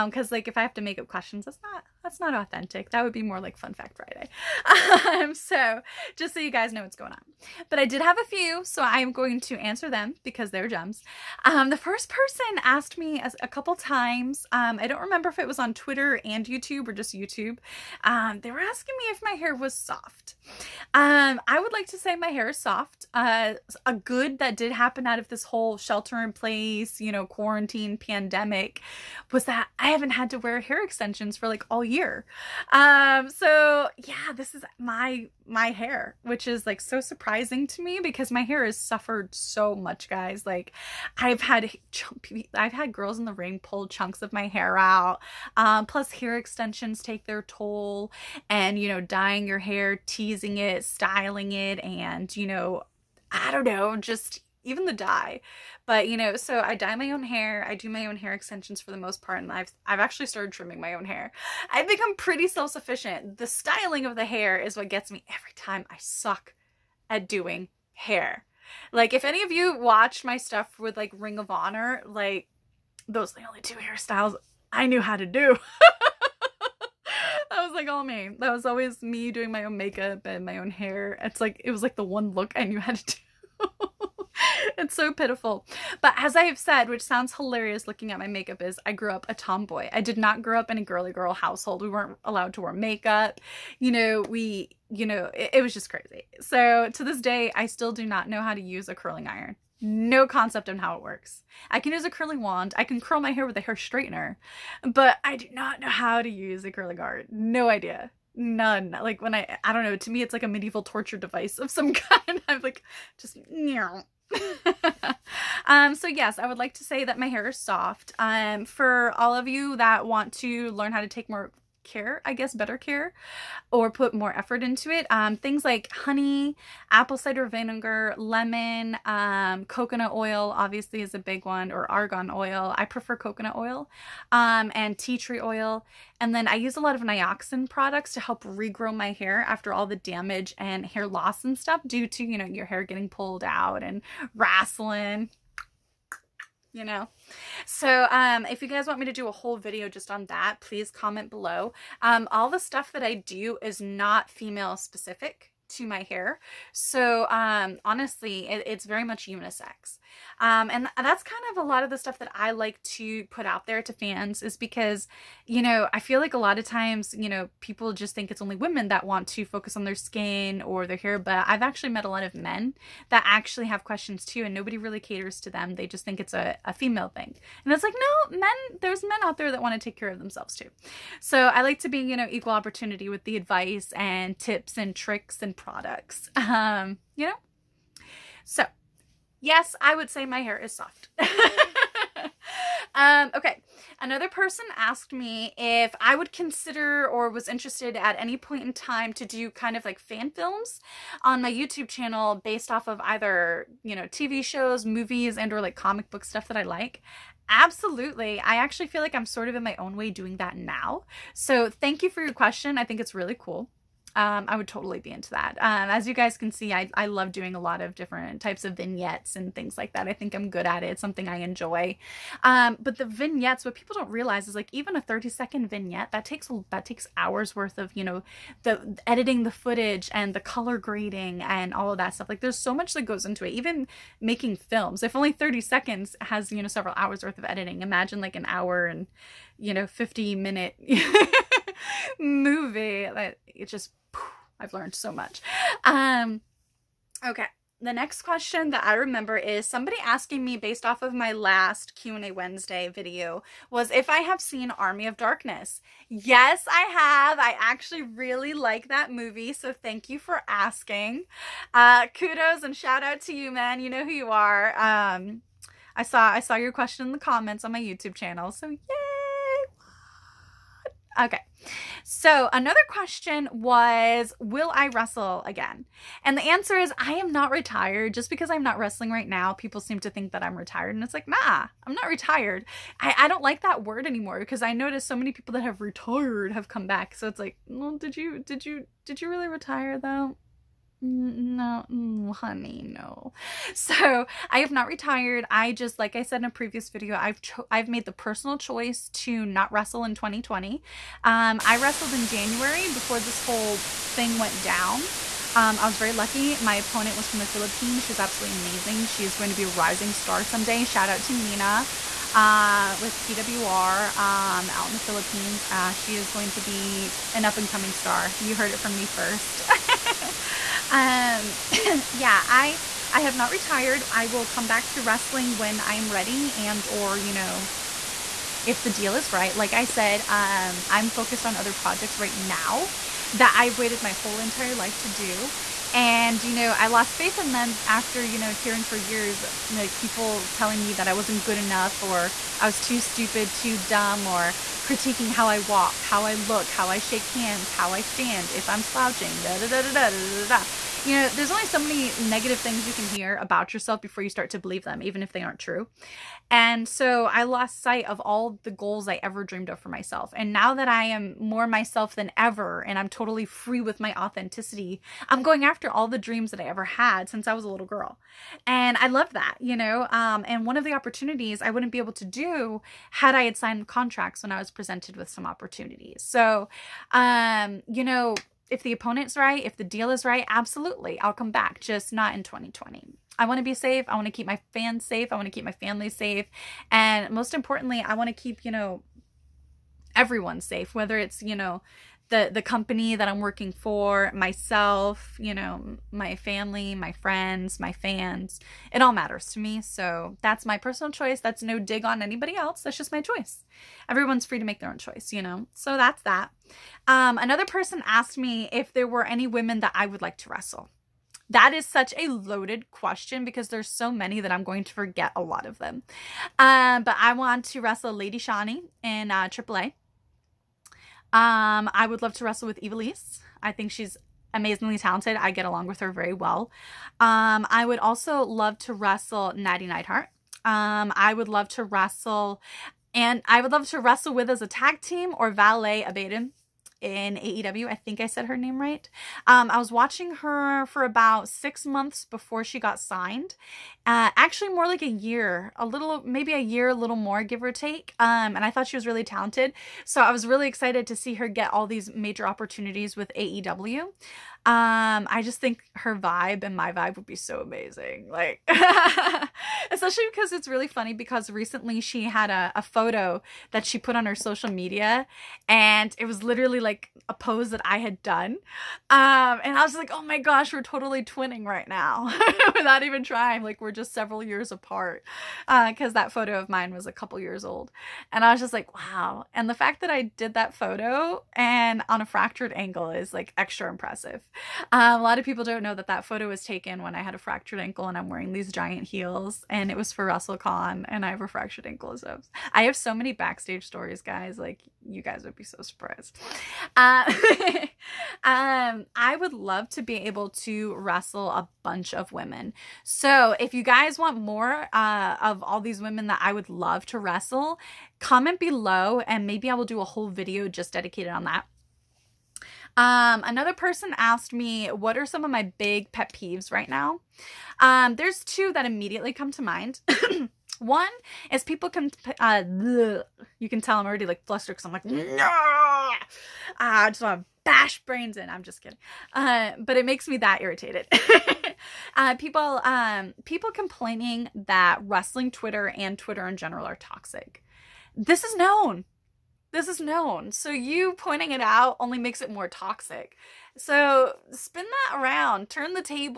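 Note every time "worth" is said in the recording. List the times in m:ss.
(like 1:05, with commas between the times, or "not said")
3:47, 3:57.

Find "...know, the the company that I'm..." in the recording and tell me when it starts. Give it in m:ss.
6:31.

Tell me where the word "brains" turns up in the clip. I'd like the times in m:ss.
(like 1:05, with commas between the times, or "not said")
8:48.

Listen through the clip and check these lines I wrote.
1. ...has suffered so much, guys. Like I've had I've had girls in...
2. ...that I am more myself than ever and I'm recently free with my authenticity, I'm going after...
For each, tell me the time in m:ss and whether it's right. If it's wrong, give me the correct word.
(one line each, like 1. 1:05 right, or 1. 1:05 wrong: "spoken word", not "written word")
1. 0:38 right
2. 6:00 wrong: "totally", not "recently".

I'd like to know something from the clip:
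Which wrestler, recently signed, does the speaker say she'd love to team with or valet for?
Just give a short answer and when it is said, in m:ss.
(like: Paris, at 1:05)
Abaddon, at 7:16.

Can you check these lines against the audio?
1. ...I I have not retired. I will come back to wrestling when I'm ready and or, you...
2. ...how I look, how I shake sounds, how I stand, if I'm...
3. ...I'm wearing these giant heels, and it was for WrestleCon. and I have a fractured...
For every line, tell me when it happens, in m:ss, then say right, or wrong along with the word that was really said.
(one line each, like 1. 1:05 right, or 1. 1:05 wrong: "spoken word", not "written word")
1. 5:22 right
2. 5:46 wrong: "hands", not "sounds"
3. 8:08 right.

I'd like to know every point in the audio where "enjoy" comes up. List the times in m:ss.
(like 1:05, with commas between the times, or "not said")
3:41.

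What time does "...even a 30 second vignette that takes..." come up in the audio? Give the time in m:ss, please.
3:44.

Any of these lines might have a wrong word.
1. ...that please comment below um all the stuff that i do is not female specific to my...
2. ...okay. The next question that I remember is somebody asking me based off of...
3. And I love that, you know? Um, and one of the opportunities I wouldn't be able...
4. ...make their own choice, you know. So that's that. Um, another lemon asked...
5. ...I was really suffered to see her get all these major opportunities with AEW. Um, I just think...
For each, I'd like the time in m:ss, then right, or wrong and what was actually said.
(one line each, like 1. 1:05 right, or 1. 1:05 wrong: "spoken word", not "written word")
1. 2:30 right
2. 4:07 right
3. 6:08 right
4. 6:44 wrong: "person", not "lemon"
5. 7:30 wrong: "excited", not "suffered".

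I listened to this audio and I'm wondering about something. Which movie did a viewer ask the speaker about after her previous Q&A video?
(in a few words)
Army of Darkness.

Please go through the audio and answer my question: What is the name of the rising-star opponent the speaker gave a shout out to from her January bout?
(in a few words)
Nina.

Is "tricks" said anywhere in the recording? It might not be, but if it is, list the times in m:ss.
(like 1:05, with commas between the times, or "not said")
3:04.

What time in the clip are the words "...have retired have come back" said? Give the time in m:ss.
4:45.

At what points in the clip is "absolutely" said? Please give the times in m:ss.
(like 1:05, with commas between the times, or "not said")
3:27, 5:08, 6:20.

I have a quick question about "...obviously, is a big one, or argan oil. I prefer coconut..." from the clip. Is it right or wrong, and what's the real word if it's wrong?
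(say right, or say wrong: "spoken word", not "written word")
right.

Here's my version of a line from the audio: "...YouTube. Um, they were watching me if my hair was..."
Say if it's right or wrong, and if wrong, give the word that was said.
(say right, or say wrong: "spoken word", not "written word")
wrong: "asking", not "watching".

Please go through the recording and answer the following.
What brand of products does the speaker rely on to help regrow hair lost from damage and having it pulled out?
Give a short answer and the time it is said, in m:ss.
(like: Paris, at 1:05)
Nioxin, at 2:17.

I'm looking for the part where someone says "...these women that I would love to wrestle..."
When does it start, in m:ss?
8:25.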